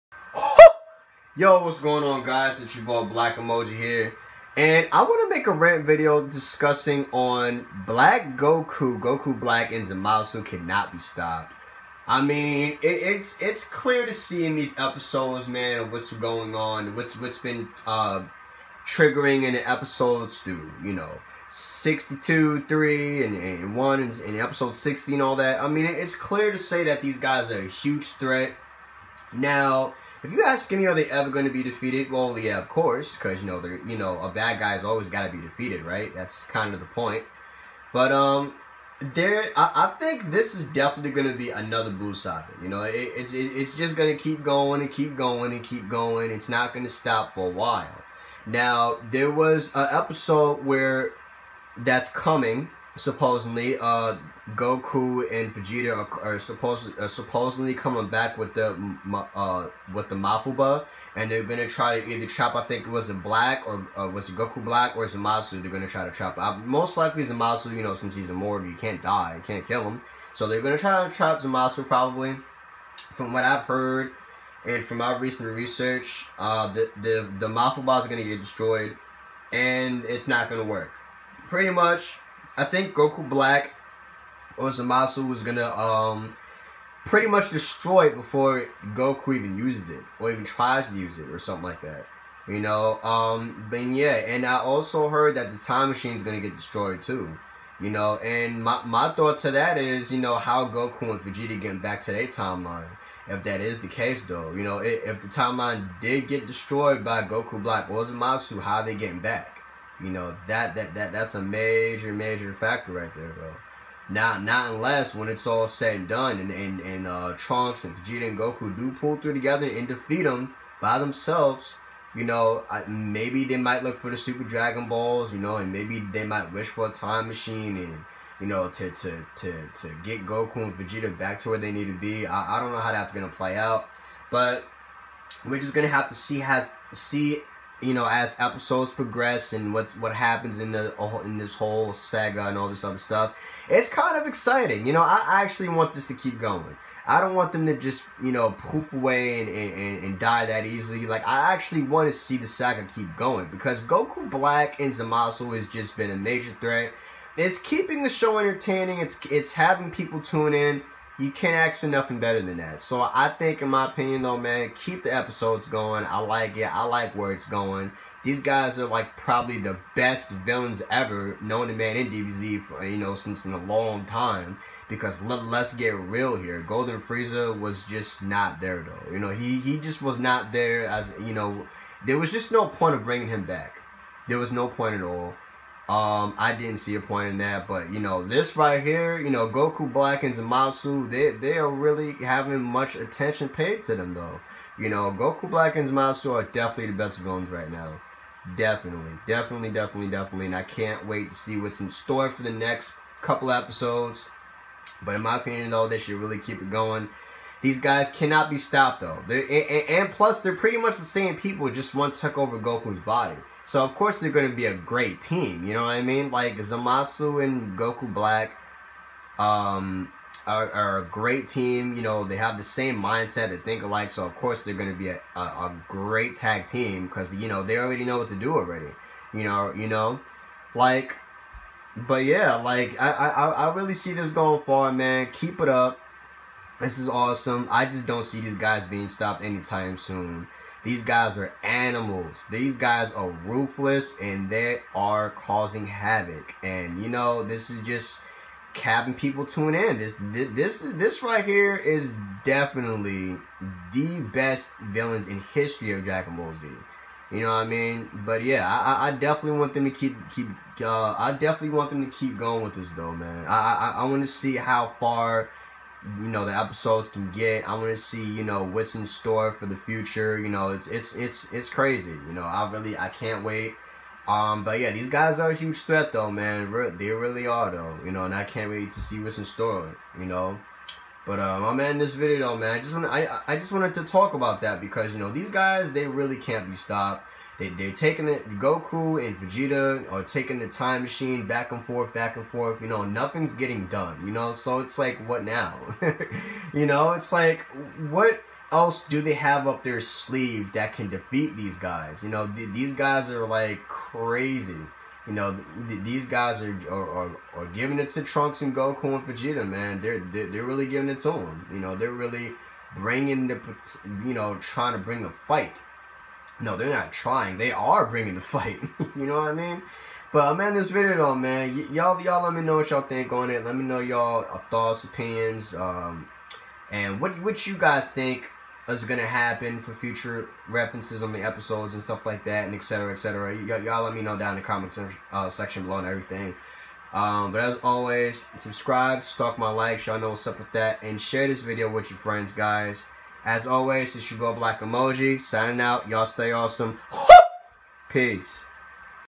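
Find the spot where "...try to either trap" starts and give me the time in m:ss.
1:01.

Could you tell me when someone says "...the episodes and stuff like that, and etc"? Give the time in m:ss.
5:31.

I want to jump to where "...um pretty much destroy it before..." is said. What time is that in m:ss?
1:25.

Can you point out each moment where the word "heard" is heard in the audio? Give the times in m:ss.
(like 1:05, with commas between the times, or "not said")
1:13, 1:35.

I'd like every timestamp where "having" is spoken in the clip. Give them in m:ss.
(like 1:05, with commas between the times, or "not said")
2:39, 3:12.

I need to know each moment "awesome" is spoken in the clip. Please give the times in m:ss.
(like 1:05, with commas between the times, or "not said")
3:57, 5:46.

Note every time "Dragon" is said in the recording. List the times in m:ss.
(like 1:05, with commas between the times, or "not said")
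2:04, 4:16.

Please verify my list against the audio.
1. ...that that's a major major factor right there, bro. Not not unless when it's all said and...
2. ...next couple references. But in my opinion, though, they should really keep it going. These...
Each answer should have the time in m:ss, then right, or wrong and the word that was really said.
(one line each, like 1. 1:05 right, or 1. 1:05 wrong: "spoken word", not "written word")
1. 1:50 right
2. 3:22 wrong: "episodes", not "references".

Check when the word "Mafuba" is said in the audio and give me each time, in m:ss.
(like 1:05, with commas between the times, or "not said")
1:00, 1:17.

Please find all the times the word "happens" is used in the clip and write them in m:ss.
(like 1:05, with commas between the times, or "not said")
2:20, 5:29.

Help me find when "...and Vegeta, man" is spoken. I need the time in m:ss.
5:09.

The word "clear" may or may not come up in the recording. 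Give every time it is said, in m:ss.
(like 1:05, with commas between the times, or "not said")
0:13, 0:26.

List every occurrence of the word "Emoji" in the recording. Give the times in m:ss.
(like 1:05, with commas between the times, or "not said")
0:03, 5:44.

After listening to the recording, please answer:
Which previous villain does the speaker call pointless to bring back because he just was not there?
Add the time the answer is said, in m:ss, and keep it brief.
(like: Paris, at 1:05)
Golden Frieza, at 2:56.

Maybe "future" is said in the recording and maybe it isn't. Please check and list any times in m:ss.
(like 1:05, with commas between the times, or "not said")
4:29, 5:29.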